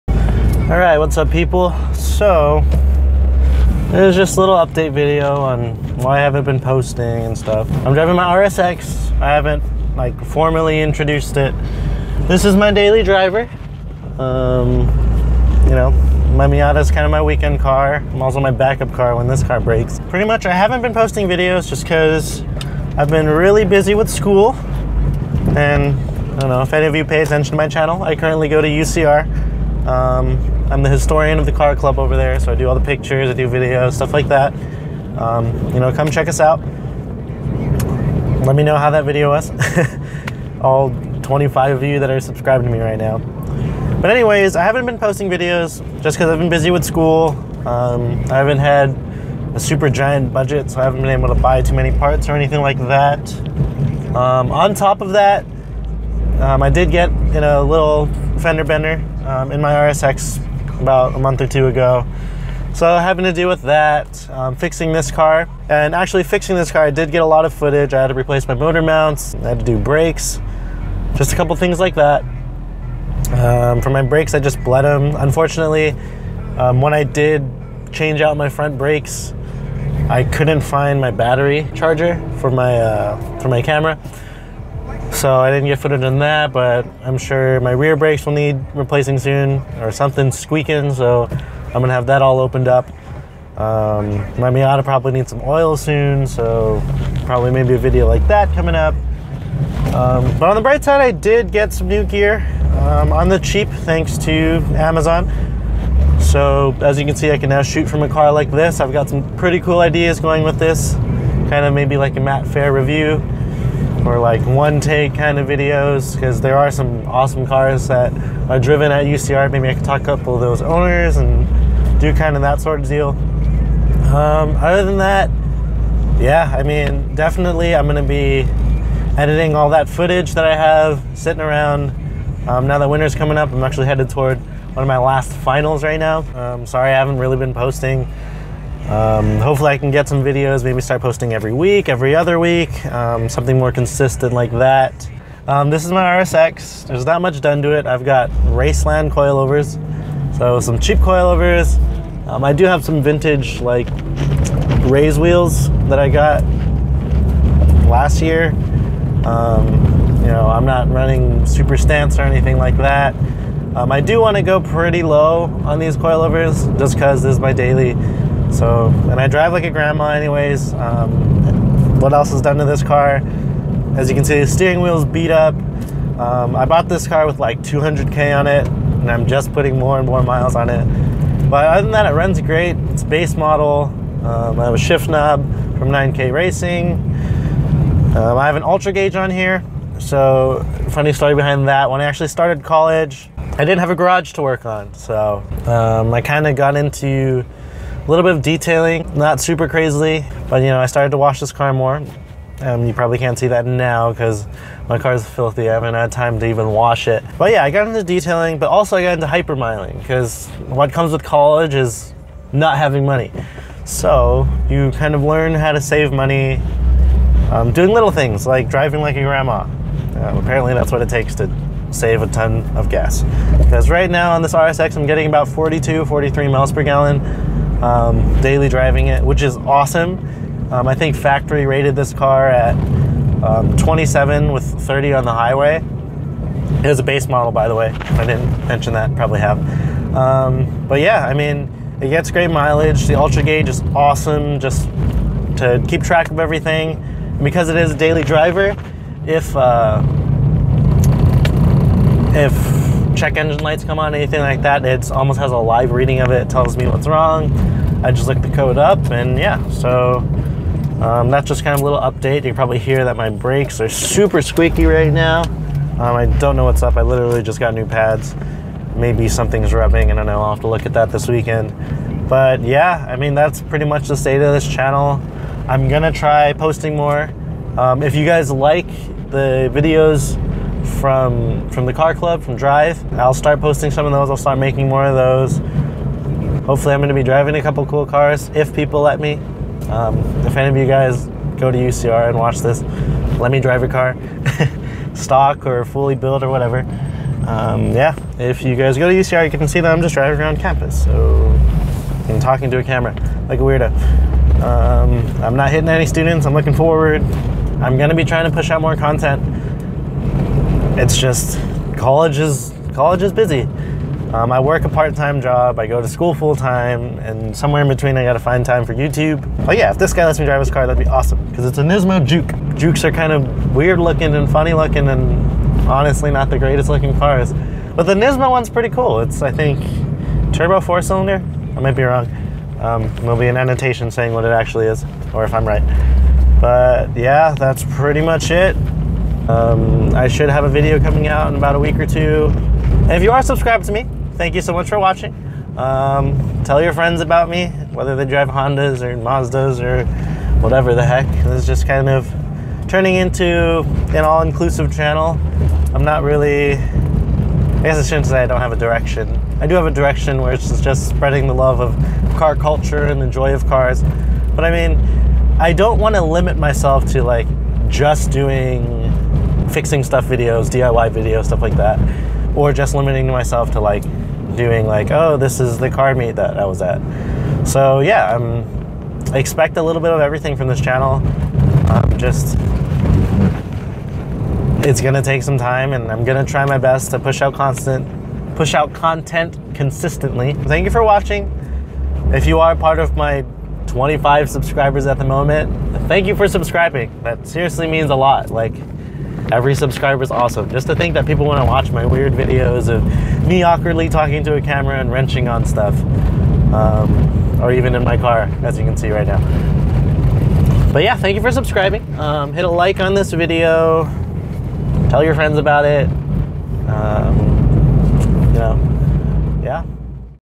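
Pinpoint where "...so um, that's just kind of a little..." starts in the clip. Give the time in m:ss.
4:19.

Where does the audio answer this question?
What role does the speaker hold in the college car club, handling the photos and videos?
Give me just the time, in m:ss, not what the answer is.
0:30.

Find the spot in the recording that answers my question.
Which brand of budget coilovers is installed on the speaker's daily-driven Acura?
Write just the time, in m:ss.
2:28.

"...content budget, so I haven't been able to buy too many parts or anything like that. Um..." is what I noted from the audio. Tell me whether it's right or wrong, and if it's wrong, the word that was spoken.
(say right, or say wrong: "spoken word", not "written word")
wrong: "giant", not "content".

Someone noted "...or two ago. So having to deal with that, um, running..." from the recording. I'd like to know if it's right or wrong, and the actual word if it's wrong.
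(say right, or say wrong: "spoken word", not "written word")
wrong: "fixing", not "running".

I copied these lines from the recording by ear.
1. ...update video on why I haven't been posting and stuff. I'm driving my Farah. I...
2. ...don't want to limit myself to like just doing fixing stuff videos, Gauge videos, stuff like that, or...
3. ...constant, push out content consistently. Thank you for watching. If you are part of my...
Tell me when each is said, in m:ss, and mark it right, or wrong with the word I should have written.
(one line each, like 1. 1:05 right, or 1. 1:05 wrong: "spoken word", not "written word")
1. 0:04 wrong: "RSX", not "Farah"
2. 6:05 wrong: "DIY", not "Gauge"
3. 6:27 right.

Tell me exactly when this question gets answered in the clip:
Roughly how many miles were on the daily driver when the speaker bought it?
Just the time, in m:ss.
2:57.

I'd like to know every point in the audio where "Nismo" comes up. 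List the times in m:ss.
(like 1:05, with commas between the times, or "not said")
5:21, 5:28.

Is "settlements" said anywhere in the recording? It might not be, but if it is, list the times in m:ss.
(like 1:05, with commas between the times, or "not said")
not said.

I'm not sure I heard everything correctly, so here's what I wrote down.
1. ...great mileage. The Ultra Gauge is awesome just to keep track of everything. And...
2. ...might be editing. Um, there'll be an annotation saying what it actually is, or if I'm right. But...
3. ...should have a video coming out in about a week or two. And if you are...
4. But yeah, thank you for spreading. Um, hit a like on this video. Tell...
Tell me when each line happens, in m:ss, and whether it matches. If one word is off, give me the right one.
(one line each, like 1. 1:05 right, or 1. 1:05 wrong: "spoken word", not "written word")
1. 4:02 right
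2. 5:31 wrong: "wrong", not "editing"
3. 5:40 right
4. 6:50 wrong: "subscribing", not "spreading".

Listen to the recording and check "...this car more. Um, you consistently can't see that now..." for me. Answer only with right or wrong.
wrong.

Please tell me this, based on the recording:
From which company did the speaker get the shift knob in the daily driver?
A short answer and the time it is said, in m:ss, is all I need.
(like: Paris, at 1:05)
9K Racing, at 3:05.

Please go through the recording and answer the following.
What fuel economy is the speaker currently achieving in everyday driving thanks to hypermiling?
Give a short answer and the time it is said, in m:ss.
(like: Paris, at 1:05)
42-43 miles per gallon, at 3:45.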